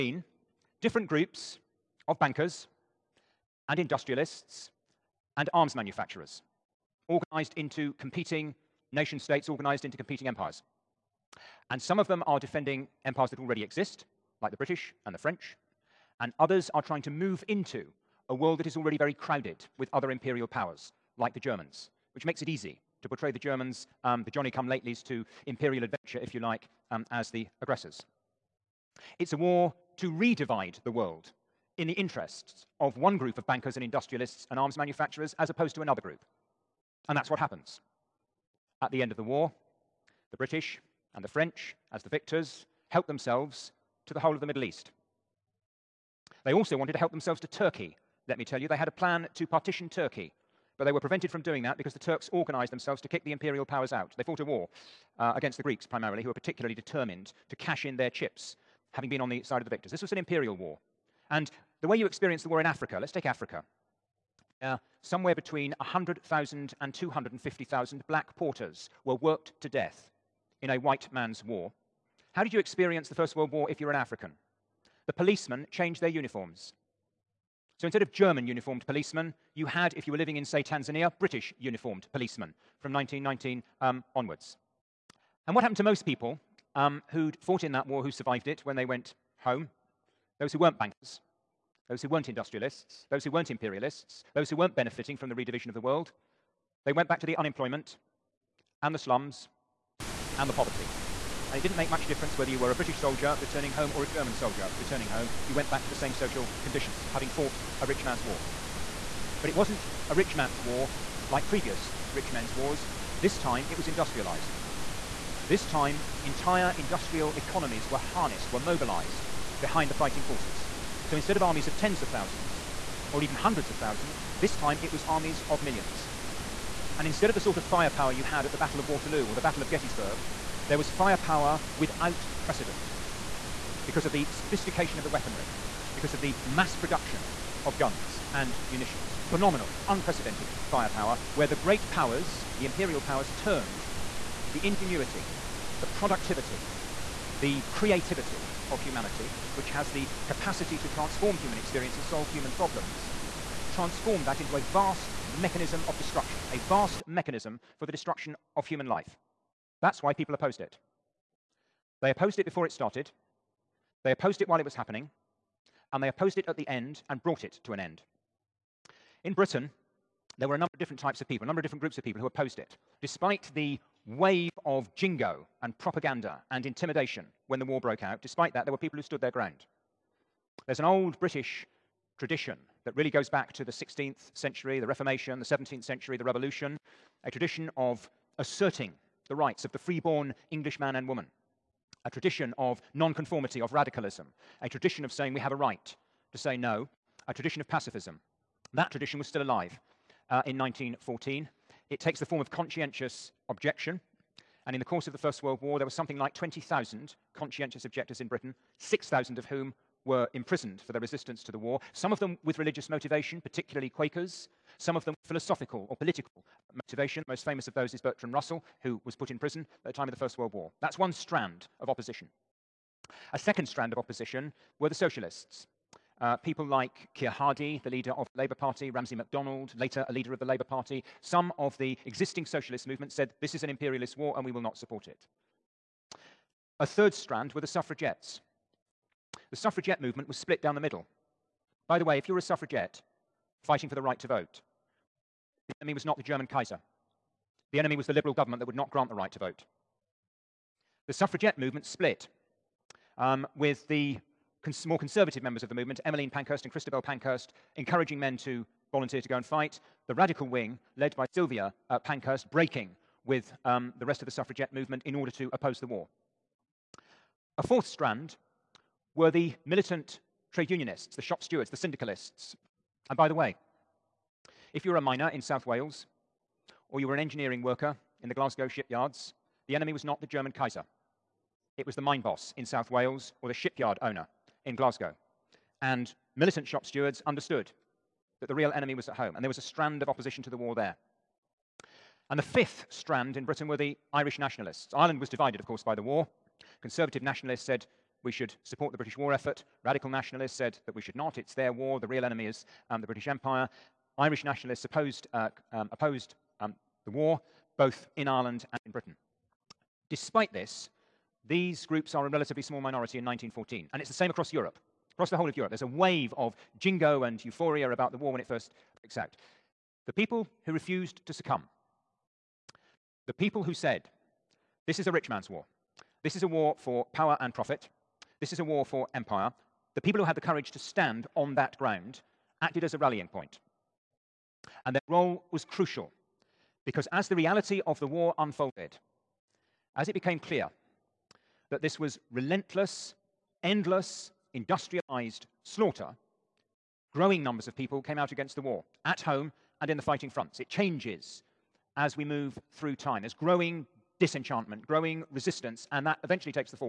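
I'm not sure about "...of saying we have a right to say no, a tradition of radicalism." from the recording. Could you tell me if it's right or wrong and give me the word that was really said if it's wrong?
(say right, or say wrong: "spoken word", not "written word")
wrong: "pacifism", not "radicalism".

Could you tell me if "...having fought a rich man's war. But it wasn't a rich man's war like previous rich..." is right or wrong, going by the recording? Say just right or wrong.
right.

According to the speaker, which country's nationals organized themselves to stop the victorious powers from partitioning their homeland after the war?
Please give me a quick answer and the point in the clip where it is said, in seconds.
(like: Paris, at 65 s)
Turks, at 51 s.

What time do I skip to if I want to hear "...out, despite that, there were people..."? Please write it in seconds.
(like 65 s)
178 s.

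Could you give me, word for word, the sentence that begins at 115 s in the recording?
This time, entire industrial economies were harnessed, were mobilized behind the fighting forces.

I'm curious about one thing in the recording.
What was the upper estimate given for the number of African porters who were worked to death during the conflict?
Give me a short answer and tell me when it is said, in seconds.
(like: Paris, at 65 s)
250,000, at 66 s.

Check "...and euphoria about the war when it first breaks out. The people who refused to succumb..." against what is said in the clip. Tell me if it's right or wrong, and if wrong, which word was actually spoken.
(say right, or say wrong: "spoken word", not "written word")
right.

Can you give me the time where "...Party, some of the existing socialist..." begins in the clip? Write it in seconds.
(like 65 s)
230 s.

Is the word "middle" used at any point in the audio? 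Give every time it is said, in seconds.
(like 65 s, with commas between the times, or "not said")
44 s, 240 s.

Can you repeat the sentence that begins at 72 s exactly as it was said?
How did you experience the First World War if you're an African?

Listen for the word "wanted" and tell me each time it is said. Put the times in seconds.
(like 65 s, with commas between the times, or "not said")
46 s.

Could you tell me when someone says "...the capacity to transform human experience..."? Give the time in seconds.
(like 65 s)
149 s.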